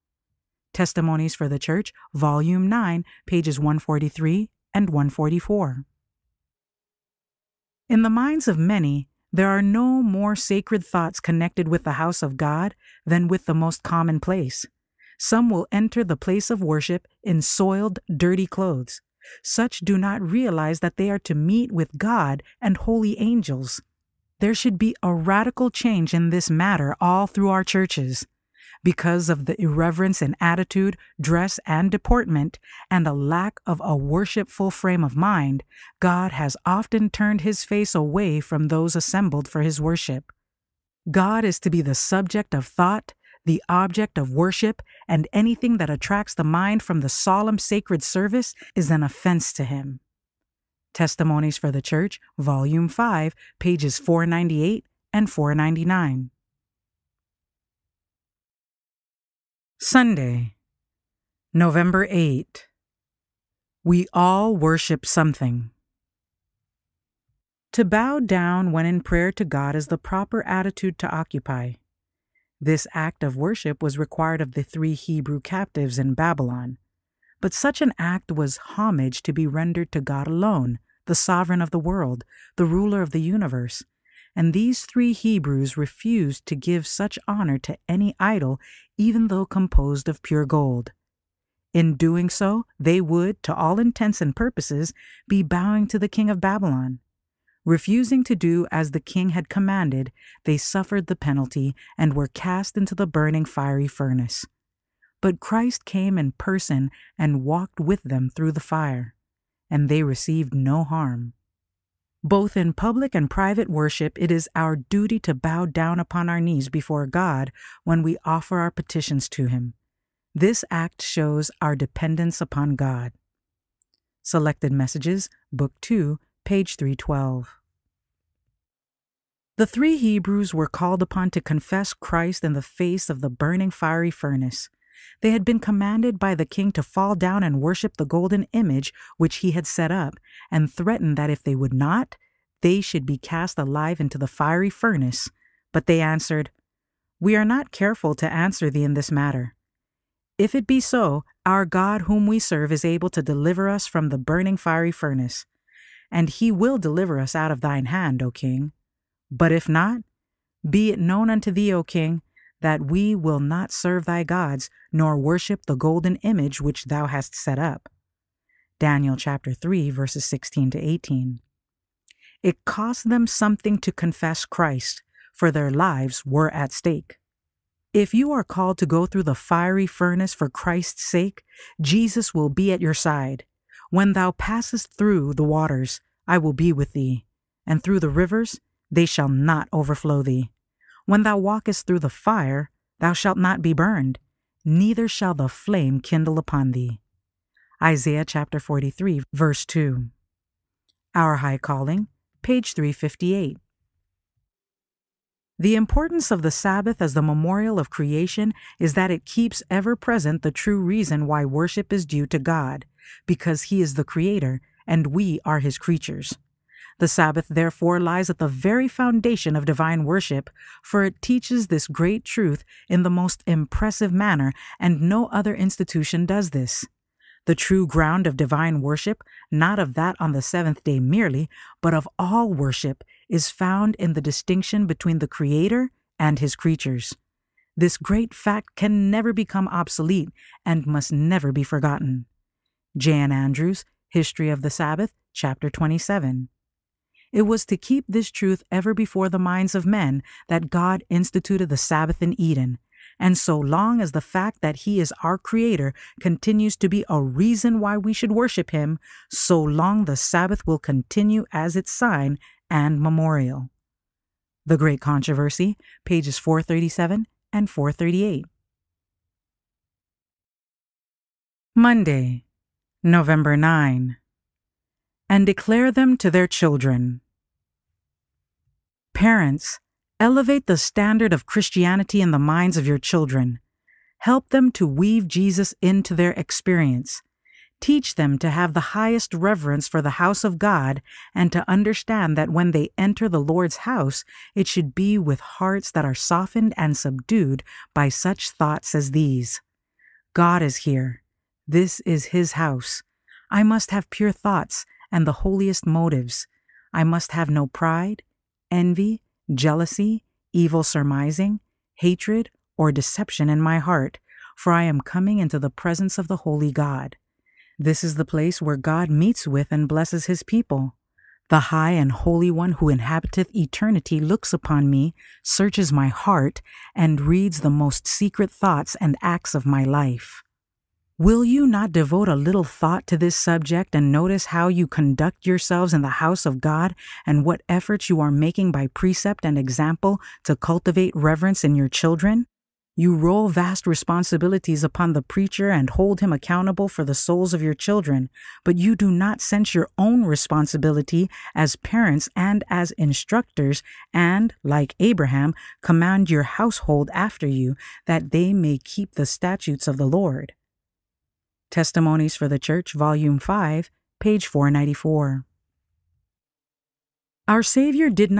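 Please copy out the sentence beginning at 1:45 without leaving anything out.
But Christ came in person and walked with them through the fire, and they received no harm.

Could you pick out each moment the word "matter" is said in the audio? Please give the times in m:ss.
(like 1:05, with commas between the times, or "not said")
0:26, 2:29.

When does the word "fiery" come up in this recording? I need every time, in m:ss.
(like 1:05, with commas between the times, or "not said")
1:43, 2:13, 2:24, 2:34, 2:59.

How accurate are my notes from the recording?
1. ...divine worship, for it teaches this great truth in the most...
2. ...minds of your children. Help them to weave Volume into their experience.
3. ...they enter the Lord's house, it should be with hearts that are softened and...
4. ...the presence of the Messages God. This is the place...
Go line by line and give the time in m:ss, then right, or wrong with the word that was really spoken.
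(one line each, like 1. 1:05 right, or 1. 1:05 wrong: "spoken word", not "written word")
1. 3:39 right
2. 4:42 wrong: "Jesus", not "Volume"
3. 4:52 right
4. 5:15 wrong: "Holy", not "Messages".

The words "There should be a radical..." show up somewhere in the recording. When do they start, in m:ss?
0:24.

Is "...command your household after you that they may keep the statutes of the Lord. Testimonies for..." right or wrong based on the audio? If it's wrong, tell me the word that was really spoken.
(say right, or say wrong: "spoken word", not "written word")
right.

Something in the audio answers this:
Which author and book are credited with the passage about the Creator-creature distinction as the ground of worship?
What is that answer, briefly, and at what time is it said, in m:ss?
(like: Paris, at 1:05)
J. N. Andrews, History of the Sabbath, at 4:02.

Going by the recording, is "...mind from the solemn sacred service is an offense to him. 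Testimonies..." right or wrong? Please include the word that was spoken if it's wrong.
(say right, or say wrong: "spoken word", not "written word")
right.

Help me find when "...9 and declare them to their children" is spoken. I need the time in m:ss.
4:33.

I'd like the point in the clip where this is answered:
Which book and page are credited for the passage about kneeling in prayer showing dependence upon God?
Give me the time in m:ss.
2:04.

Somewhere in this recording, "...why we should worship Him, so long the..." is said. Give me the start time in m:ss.
4:17.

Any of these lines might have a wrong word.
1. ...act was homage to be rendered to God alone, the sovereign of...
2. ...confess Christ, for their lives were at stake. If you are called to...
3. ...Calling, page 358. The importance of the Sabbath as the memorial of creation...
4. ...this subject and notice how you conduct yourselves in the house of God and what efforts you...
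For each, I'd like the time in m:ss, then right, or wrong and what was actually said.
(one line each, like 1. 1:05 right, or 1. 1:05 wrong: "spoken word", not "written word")
1. 1:17 right
2. 2:53 right
3. 3:21 right
4. 5:33 right.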